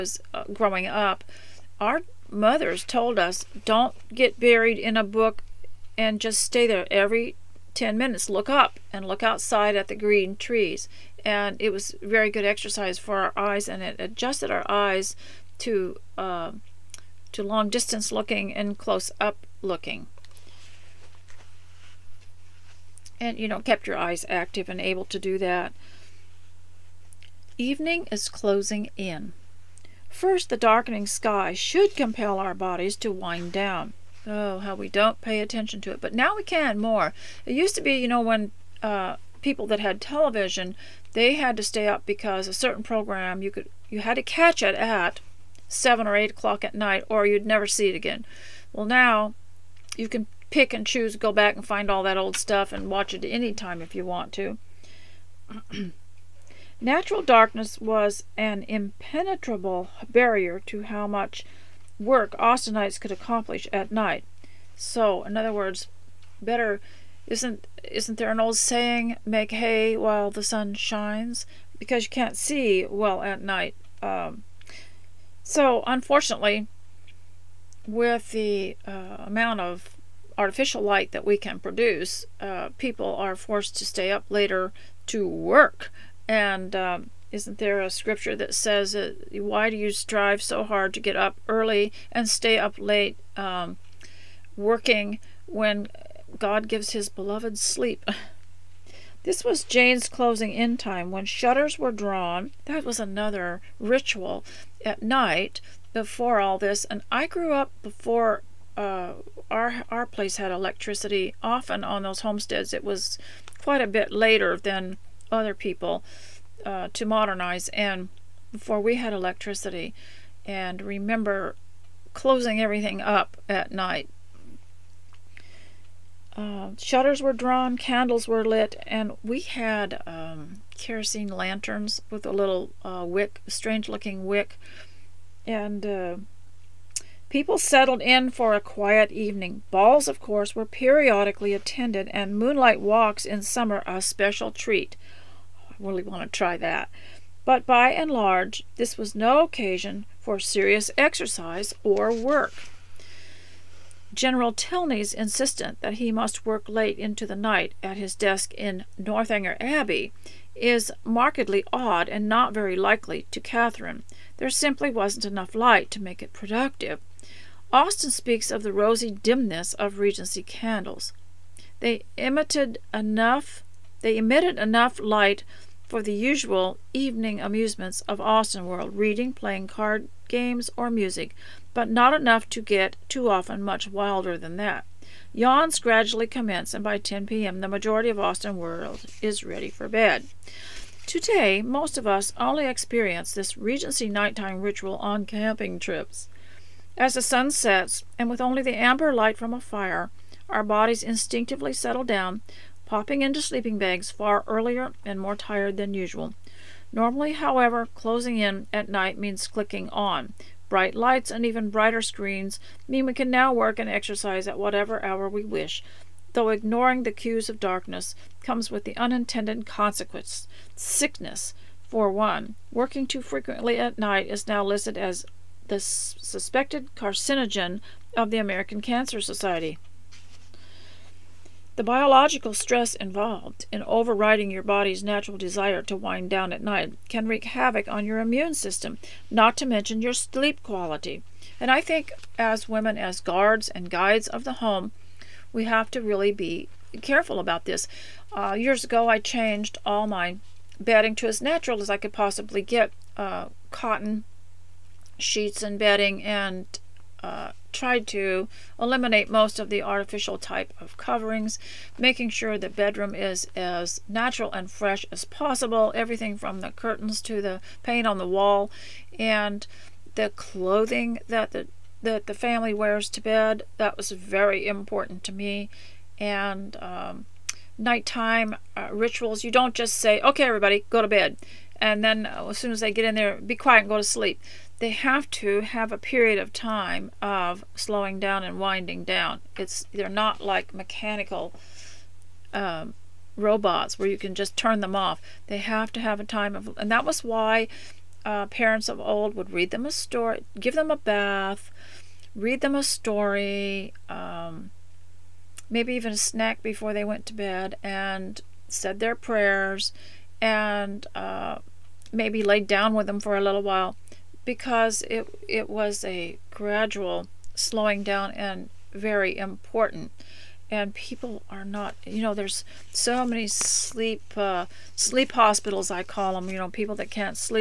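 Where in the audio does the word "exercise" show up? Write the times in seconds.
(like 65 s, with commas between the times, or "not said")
12 s, 150 s, 213 s.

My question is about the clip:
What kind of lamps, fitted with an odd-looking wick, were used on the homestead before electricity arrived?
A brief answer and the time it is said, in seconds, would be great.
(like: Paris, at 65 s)
Kerosene lanterns, at 130 s.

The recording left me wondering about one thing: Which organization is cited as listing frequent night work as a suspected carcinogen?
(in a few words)
American Cancer Society.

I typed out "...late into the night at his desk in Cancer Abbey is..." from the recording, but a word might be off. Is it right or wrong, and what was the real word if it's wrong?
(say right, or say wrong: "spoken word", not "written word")
wrong: "Northanger", not "Cancer".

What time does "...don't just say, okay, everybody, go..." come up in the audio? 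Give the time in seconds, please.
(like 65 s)
279 s.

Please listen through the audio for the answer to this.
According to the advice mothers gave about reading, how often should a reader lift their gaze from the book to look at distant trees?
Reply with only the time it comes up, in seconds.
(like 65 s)
6 s.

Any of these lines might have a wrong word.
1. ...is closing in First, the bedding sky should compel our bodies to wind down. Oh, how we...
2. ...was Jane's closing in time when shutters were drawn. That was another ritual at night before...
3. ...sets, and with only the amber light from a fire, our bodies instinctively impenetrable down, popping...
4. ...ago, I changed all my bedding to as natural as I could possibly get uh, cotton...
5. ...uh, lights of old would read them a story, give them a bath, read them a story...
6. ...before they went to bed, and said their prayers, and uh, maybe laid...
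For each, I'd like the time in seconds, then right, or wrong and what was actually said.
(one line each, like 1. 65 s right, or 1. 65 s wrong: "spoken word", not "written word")
1. 28 s wrong: "darkening", not "bedding"
2. 99 s right
3. 197 s wrong: "settle", not "impenetrable"
4. 248 s right
5. 298 s wrong: "parents", not "lights"
6. 306 s right.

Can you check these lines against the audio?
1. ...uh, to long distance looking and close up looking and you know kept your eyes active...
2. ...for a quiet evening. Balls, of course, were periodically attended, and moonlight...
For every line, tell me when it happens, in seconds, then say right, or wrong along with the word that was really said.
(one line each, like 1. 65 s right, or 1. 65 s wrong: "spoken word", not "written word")
1. 16 s right
2. 138 s right.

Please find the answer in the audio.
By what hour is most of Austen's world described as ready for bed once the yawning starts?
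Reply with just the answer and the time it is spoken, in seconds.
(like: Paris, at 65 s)
10 p.m., at 186 s.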